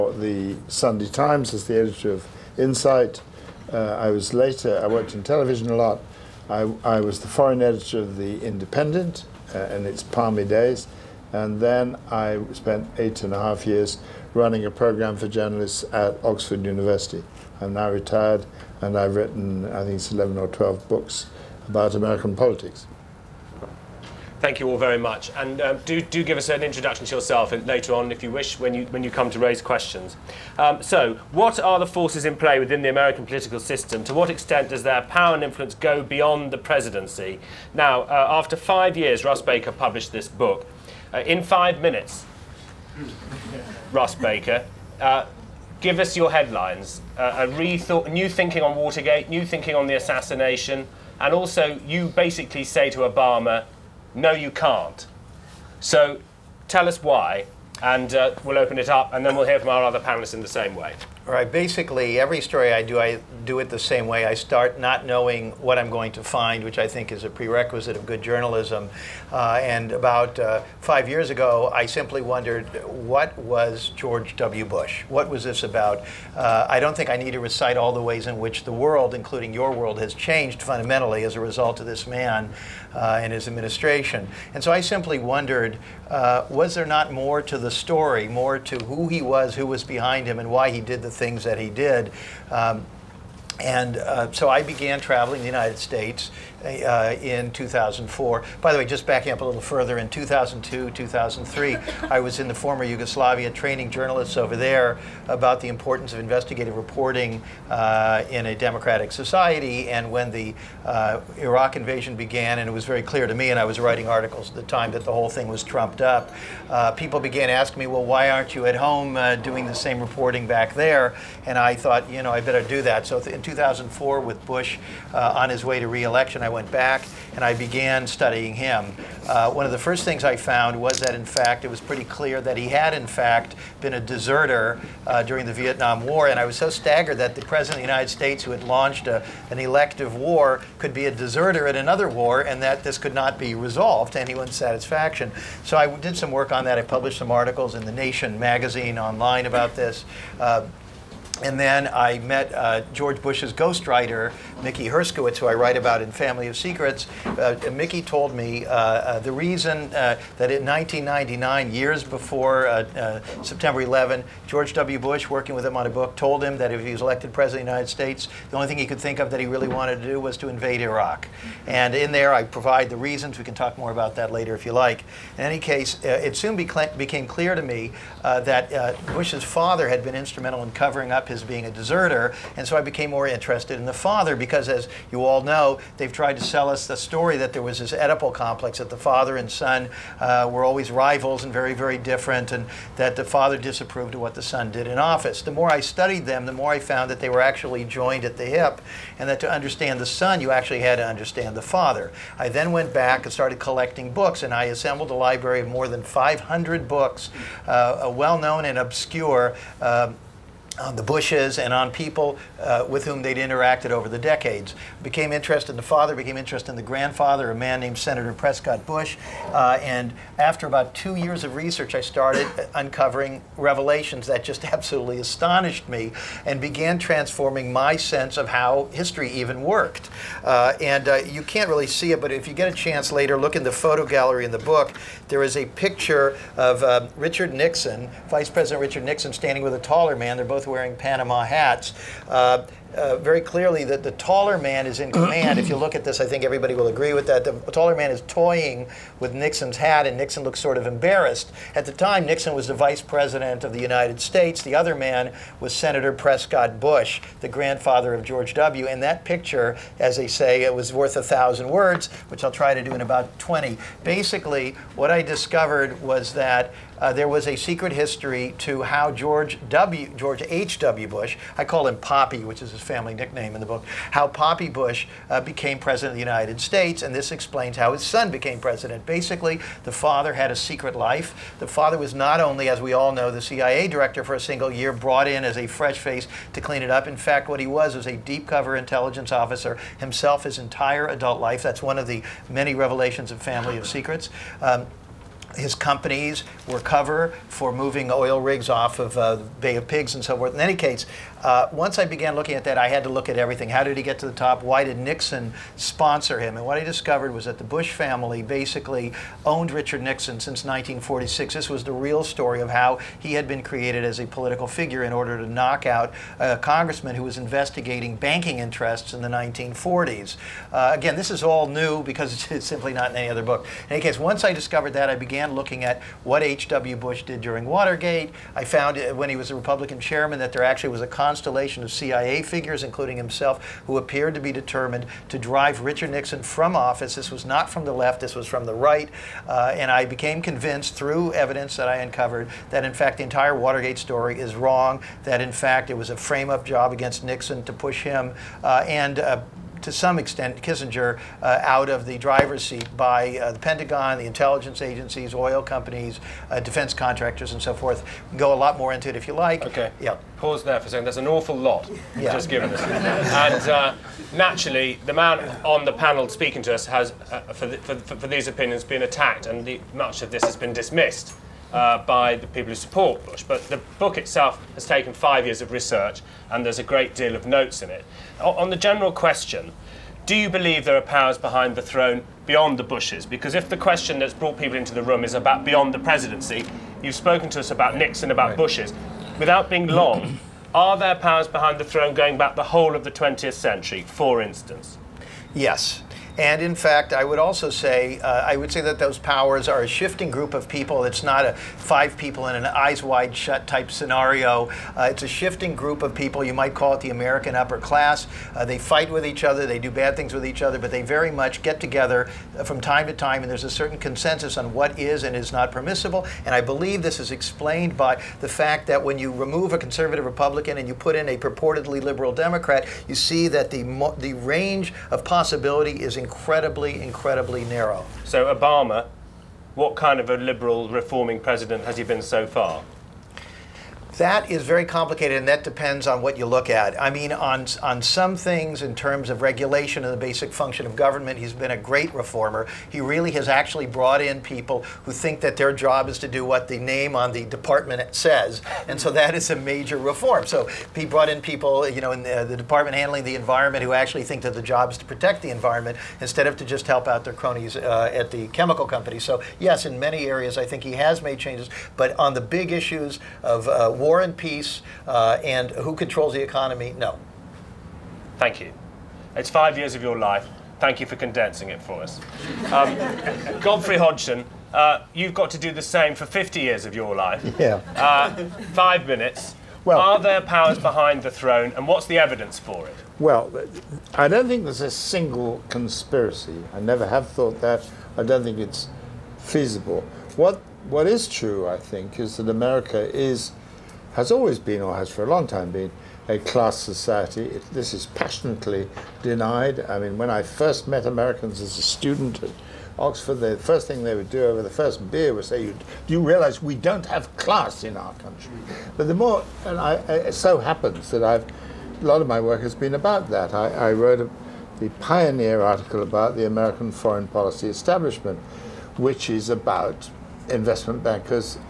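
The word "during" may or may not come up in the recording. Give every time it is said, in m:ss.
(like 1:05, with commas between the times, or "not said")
2:15, 5:27.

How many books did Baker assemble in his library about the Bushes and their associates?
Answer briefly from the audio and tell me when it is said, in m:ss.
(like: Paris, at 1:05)
more than 500, at 3:25.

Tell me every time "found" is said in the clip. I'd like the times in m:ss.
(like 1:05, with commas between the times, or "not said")
2:10, 3:16, 5:28.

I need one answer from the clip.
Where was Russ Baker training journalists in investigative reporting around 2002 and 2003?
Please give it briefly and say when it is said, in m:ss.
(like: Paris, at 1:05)
former Yugoslavia, at 1:42.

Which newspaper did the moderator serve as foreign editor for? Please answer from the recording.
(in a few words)
The Independent.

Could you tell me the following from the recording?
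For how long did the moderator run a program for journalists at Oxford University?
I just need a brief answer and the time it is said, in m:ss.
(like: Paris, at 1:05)
8 and a half years, at 0:12.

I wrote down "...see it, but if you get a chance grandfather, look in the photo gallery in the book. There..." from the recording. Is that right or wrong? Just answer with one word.
wrong.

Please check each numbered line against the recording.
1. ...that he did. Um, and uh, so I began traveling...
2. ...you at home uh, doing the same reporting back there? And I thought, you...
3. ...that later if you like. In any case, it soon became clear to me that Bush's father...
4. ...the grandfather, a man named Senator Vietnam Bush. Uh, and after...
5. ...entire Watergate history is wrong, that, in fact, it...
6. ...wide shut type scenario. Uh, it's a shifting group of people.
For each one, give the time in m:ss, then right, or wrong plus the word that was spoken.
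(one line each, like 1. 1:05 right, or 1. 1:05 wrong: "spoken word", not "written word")
1. 1:31 right
2. 1:58 right
3. 2:54 right
4. 3:36 wrong: "Prescott", not "Vietnam"
5. 5:43 wrong: "story", not "history"
6. 6:43 right.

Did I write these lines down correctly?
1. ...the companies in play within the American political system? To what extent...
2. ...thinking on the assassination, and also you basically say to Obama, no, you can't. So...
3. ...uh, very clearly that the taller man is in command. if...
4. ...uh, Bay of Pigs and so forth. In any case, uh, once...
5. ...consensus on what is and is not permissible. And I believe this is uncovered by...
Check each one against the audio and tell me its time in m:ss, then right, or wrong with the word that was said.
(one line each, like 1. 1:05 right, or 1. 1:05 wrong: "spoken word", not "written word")
1. 0:31 wrong: "forces", not "companies"
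2. 0:49 right
3. 4:02 right
4. 4:59 right
5. 6:53 wrong: "explained", not "uncovered".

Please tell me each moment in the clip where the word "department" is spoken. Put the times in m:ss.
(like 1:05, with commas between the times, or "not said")
7:27, 7:32.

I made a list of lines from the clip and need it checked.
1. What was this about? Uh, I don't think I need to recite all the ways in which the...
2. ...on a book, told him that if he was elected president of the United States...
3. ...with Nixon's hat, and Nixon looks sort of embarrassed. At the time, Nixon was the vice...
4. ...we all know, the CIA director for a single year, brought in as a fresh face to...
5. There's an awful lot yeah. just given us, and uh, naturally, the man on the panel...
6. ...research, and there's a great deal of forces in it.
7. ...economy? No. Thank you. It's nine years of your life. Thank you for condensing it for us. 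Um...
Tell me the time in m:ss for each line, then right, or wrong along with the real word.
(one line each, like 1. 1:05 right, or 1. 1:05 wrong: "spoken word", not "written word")
1. 1:15 right
2. 2:45 right
3. 4:09 right
4. 4:42 right
5. 6:01 right
6. 6:15 wrong: "notes", not "forces"
7. 7:46 wrong: "five", not "nine".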